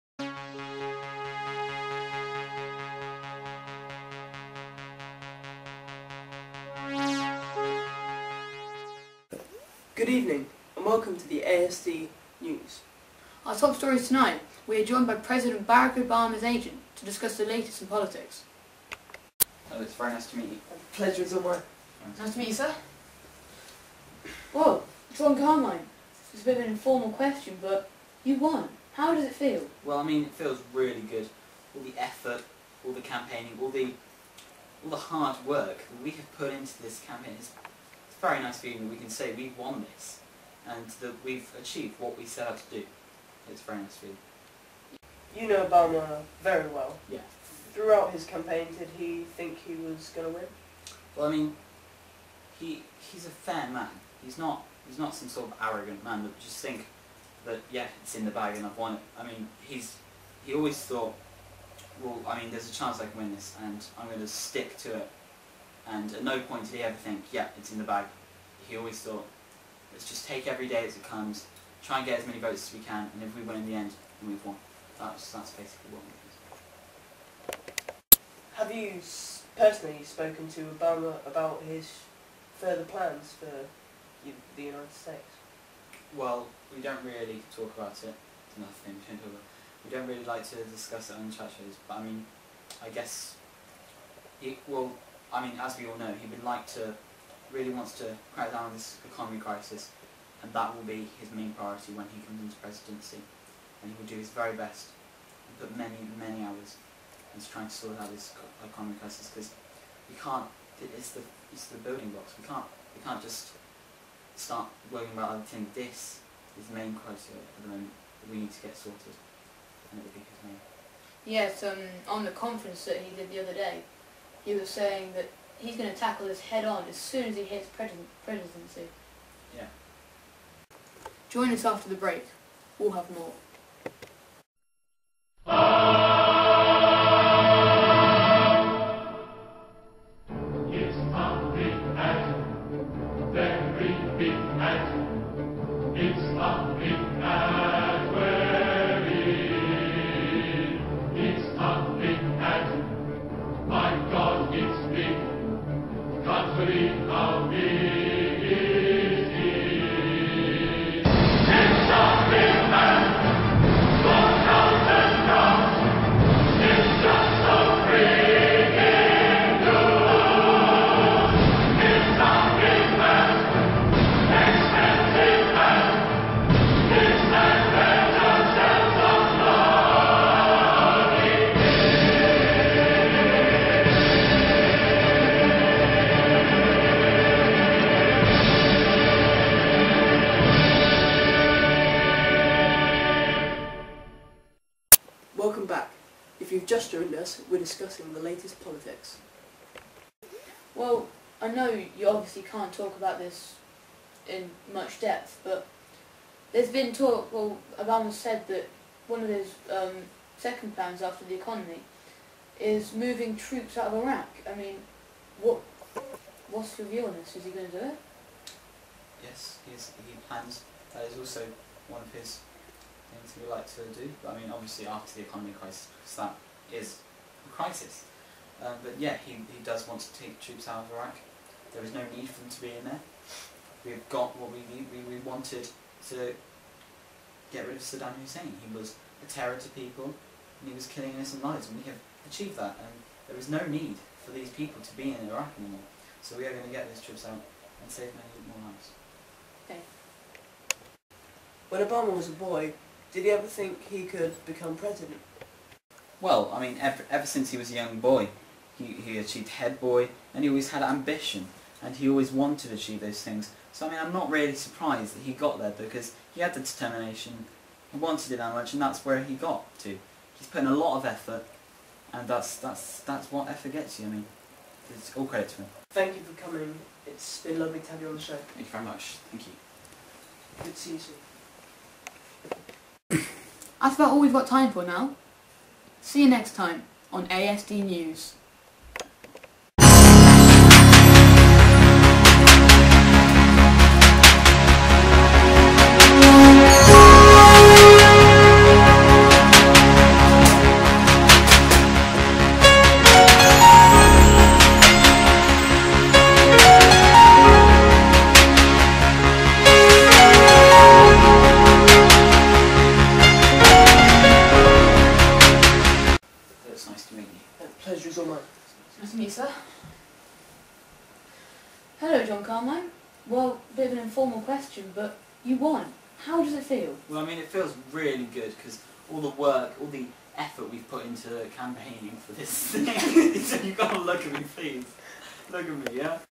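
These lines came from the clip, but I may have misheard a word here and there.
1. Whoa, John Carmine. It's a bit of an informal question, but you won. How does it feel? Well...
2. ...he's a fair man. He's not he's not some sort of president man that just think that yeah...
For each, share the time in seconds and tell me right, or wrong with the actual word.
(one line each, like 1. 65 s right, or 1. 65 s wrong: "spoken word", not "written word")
1. 24 s right
2. 53 s wrong: "arrogant", not "president".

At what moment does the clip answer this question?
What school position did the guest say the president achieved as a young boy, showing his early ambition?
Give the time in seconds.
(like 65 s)
259 s.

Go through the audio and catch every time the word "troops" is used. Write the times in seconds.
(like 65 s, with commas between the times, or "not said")
213 s, 230 s, 247 s.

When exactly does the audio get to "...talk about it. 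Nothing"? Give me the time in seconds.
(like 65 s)
87 s.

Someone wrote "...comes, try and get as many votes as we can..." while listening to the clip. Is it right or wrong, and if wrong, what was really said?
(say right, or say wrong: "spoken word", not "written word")
right.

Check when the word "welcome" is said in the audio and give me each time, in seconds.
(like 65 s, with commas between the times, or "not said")
10 s.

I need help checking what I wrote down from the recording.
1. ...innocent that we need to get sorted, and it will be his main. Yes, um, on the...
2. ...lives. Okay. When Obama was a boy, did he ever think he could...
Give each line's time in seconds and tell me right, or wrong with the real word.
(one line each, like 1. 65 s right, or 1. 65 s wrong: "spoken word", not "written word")
1. 117 s wrong: "moment", not "innocent"
2. 248 s right.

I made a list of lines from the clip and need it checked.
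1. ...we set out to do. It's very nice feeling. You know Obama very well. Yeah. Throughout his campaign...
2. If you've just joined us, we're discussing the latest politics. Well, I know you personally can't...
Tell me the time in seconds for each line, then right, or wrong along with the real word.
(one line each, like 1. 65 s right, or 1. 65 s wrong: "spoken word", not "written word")
1. 42 s right
2. 196 s wrong: "obviously", not "personally".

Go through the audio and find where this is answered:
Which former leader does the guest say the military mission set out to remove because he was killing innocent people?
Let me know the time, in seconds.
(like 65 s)
237 s.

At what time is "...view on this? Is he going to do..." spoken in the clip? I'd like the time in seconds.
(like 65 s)
216 s.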